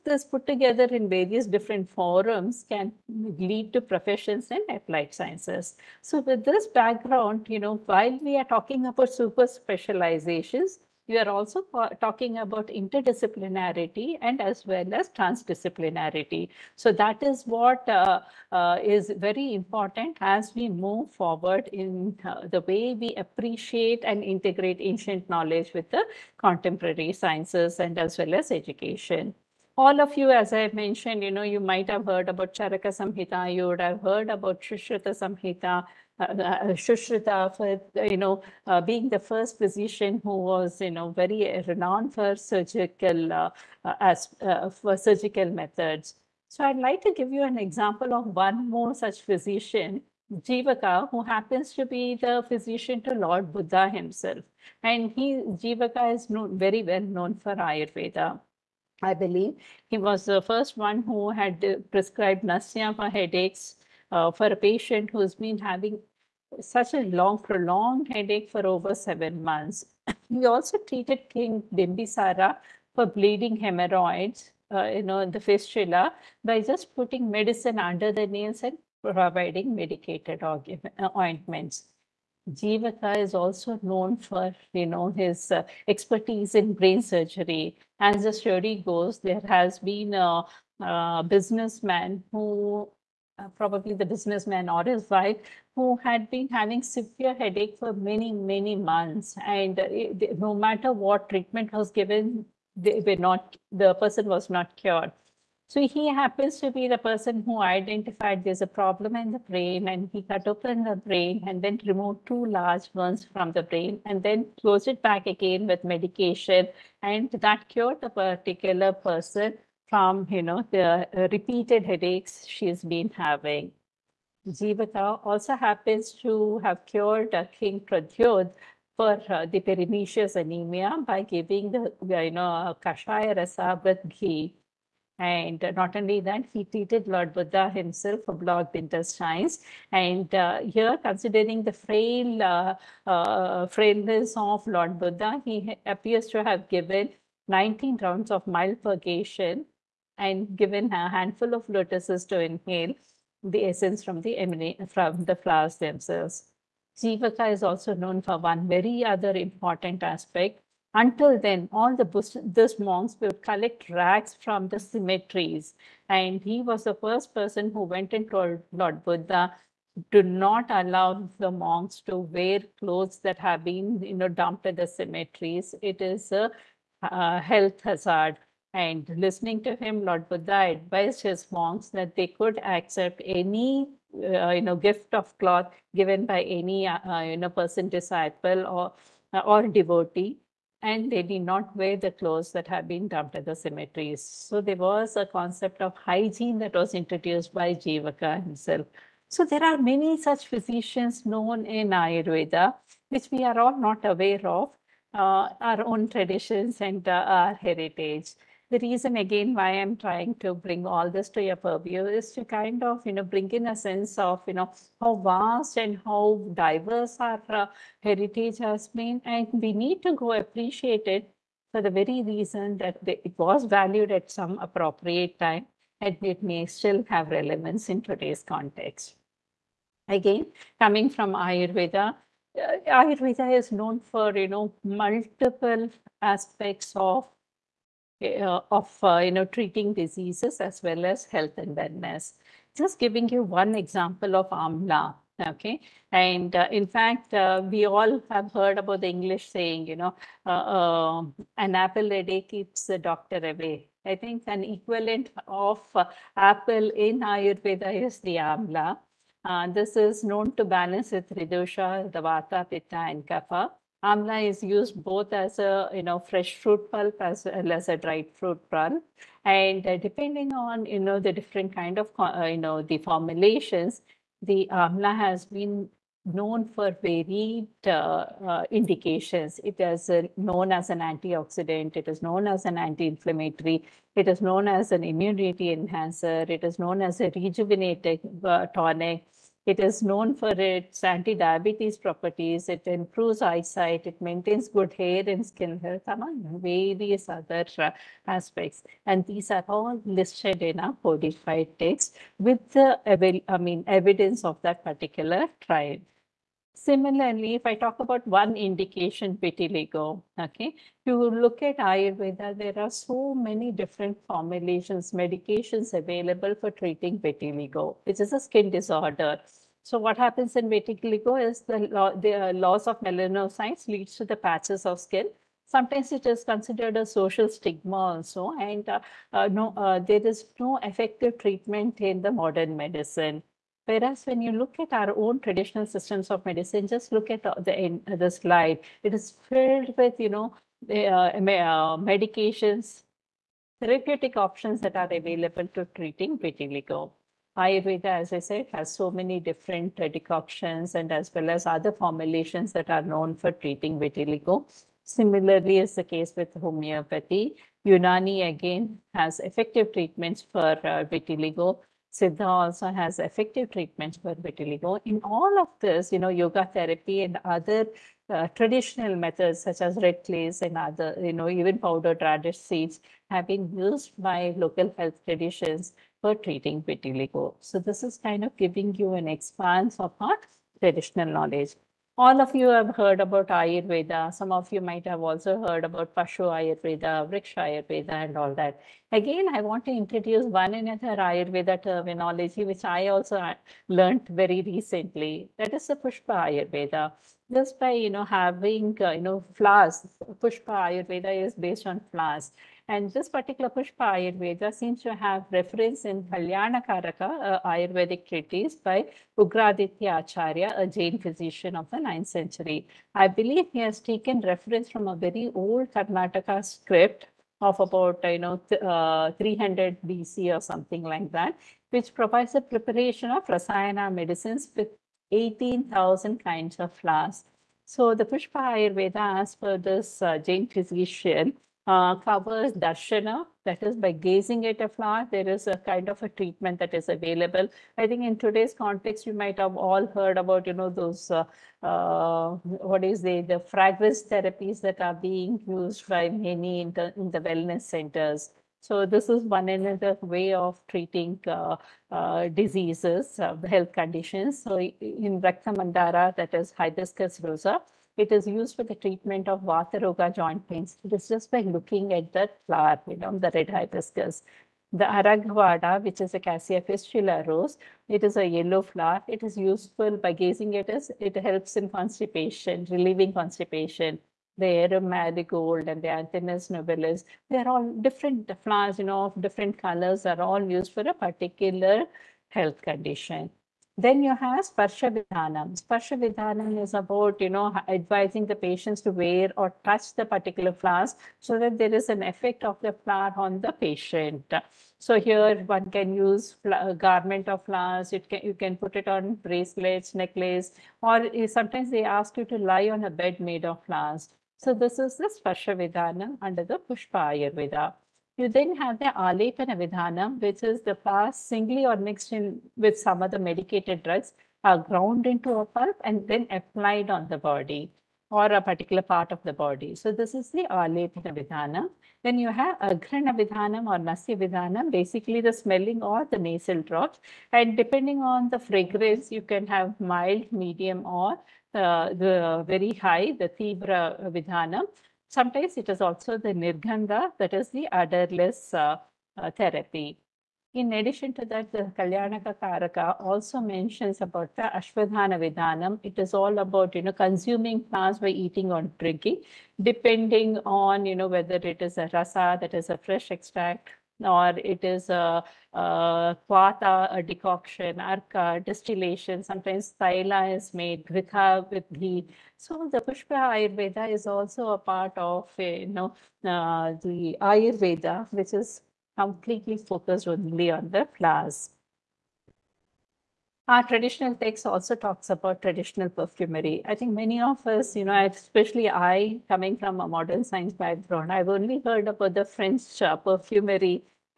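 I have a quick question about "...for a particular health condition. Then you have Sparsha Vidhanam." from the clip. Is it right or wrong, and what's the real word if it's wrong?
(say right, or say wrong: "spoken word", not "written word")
right.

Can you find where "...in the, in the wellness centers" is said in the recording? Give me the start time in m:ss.
7:26.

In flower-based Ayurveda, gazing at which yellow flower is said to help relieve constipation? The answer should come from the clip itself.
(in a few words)
Aragvada.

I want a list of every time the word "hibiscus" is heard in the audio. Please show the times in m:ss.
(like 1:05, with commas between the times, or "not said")
7:36, 7:43.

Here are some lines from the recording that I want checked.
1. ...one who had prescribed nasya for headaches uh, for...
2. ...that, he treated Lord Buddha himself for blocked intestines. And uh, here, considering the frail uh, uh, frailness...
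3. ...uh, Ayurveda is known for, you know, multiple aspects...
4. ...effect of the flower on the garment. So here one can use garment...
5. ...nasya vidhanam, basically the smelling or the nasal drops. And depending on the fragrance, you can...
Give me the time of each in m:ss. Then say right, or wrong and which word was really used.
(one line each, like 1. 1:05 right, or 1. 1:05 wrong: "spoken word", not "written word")
1. 1:00 right
2. 2:16 right
3. 3:52 right
4. 8:12 wrong: "patient", not "garment"
5. 8:43 right.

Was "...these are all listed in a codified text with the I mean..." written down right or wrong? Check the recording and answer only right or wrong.
right.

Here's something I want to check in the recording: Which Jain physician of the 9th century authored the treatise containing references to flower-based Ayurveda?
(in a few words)
Ugraditya Acharya.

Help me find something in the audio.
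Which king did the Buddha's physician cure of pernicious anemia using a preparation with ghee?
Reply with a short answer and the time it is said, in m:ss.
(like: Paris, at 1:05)
Pradyod, at 2:07.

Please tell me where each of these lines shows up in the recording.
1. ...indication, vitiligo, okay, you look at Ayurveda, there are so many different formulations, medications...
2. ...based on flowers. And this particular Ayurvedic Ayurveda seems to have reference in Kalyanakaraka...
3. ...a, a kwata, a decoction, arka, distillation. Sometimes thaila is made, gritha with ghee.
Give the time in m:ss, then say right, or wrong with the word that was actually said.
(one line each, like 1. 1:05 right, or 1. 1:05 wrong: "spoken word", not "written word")
1. 5:08 right
2. 6:41 wrong: "Pushpa", not "Ayurvedic"
3. 9:15 right.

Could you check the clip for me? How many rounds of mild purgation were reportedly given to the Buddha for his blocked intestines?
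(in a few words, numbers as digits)
19.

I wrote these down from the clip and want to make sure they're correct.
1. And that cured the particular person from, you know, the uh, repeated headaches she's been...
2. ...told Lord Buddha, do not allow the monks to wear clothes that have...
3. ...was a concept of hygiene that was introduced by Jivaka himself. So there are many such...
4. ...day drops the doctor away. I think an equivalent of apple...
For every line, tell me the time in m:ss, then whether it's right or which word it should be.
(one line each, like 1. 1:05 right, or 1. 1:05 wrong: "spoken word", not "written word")
1. 1:57 right
2. 2:48 right
3. 3:14 right
4. 4:12 wrong: "keeps", not "drops".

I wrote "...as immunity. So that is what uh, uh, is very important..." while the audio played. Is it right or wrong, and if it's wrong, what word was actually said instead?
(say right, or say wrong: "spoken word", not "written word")
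wrong: "transdisciplinarity", not "immunity".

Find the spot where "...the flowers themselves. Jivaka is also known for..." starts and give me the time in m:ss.
2:35.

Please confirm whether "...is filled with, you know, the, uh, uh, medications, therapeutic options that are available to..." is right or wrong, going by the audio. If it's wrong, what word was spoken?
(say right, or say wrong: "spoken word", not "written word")
right.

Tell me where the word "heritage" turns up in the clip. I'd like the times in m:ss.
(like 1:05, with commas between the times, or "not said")
3:27, 3:38.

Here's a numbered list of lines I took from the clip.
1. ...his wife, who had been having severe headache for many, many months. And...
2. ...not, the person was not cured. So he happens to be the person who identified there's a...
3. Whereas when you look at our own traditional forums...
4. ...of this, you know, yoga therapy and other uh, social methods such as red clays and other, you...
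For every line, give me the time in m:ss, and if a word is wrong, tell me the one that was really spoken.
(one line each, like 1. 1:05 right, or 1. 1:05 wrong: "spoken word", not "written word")
1. 1:34 right
2. 1:43 right
3. 5:33 wrong: "systems", not "forums"
4. 6:05 wrong: "traditional", not "social".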